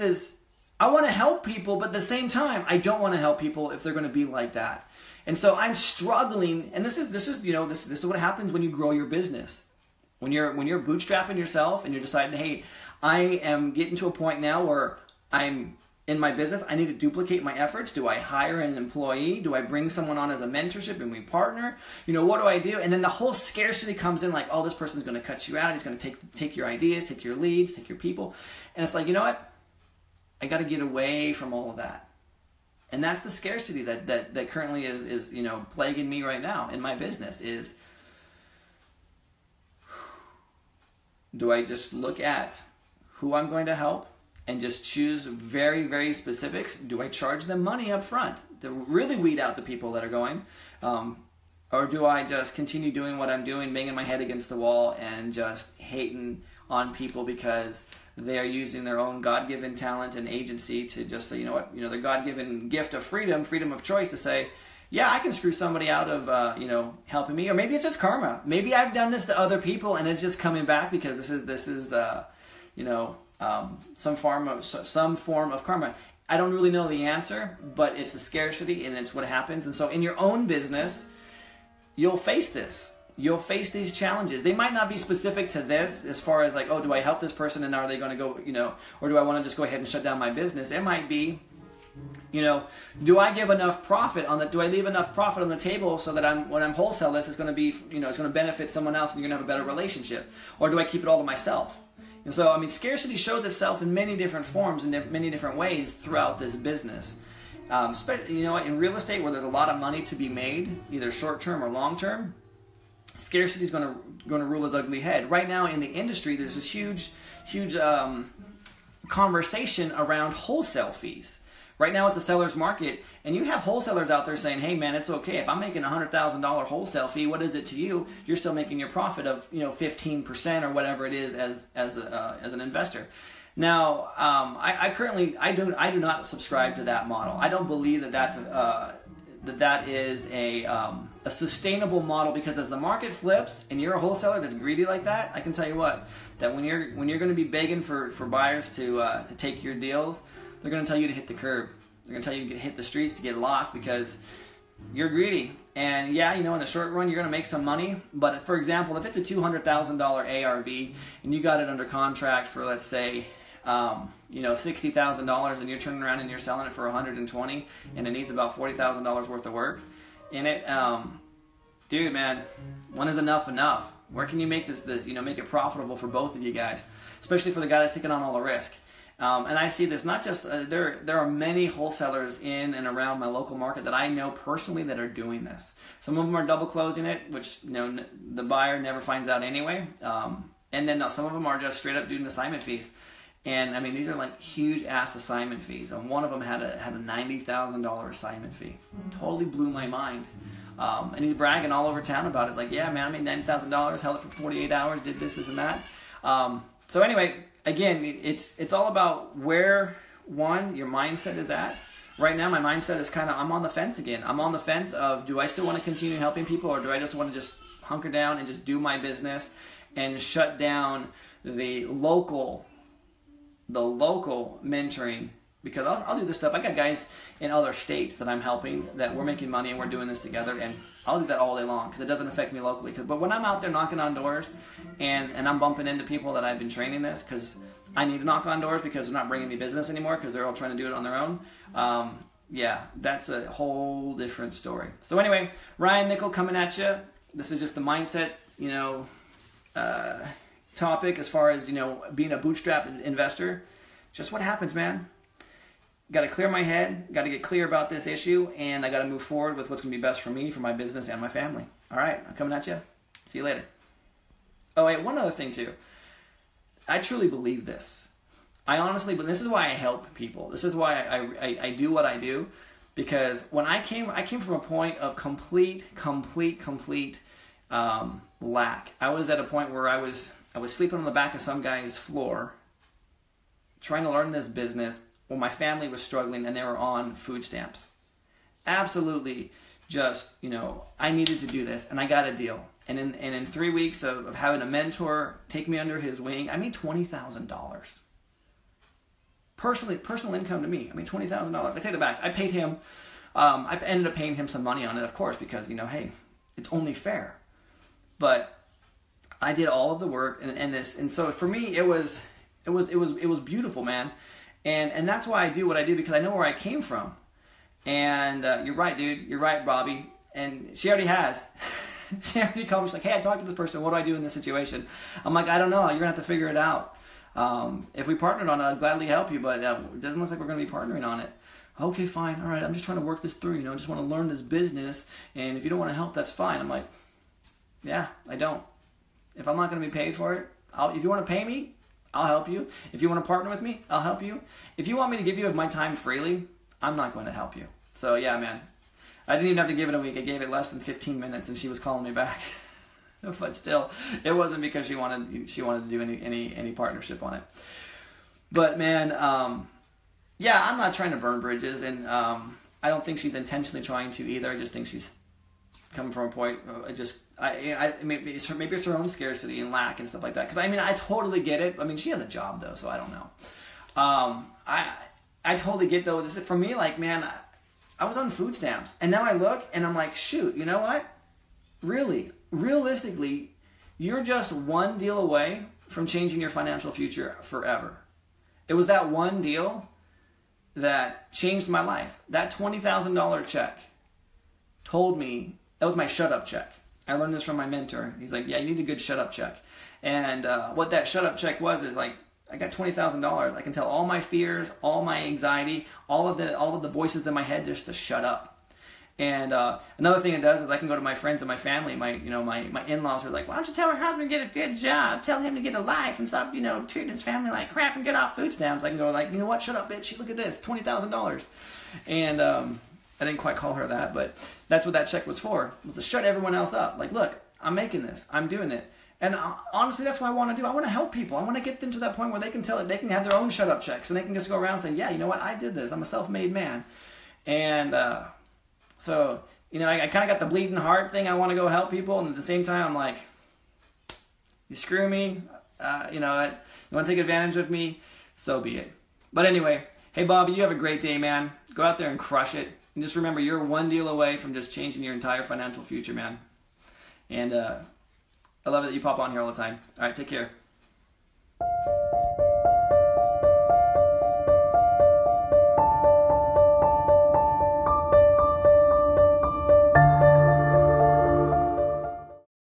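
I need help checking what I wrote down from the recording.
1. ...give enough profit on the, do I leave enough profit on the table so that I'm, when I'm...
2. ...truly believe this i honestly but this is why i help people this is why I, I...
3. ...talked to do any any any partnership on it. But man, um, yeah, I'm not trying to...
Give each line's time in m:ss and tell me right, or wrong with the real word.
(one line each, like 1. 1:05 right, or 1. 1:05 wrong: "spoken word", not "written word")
1. 1:33 right
2. 4:26 right
3. 5:55 wrong: "wanted", not "talked".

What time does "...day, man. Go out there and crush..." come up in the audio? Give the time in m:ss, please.
7:31.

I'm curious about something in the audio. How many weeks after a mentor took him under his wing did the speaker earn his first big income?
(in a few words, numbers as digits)
3 weeks.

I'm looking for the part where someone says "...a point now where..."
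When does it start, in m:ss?
0:14.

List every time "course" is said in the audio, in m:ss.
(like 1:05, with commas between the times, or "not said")
5:05.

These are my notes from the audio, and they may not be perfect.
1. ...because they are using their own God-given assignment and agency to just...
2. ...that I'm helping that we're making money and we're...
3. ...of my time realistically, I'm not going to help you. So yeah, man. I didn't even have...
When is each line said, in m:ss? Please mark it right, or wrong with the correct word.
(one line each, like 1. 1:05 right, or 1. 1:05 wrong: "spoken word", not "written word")
1. 0:57 wrong: "talent", not "assignment"
2. 3:48 right
3. 5:45 wrong: "freely", not "realistically".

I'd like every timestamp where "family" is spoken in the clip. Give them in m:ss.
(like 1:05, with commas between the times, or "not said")
4:21, 4:45, 6:51, 6:57.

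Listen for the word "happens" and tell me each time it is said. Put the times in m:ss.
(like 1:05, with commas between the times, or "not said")
0:08, 1:19, 4:14.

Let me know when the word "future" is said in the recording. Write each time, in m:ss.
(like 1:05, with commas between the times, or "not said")
6:26, 7:35.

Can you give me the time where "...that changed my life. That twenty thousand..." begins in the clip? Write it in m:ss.
6:30.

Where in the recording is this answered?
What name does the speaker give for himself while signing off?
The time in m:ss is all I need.
4:05.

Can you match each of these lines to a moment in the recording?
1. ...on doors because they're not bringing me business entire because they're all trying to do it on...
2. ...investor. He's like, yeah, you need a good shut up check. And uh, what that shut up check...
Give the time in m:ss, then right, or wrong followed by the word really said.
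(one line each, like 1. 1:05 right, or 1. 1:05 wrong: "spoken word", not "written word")
1. 3:58 wrong: "anymore", not "entire"
2. 6:37 wrong: "mentor", not "investor".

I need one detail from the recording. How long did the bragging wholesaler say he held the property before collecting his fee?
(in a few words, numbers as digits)
48 hours.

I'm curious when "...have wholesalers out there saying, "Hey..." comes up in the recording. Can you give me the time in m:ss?
2:03.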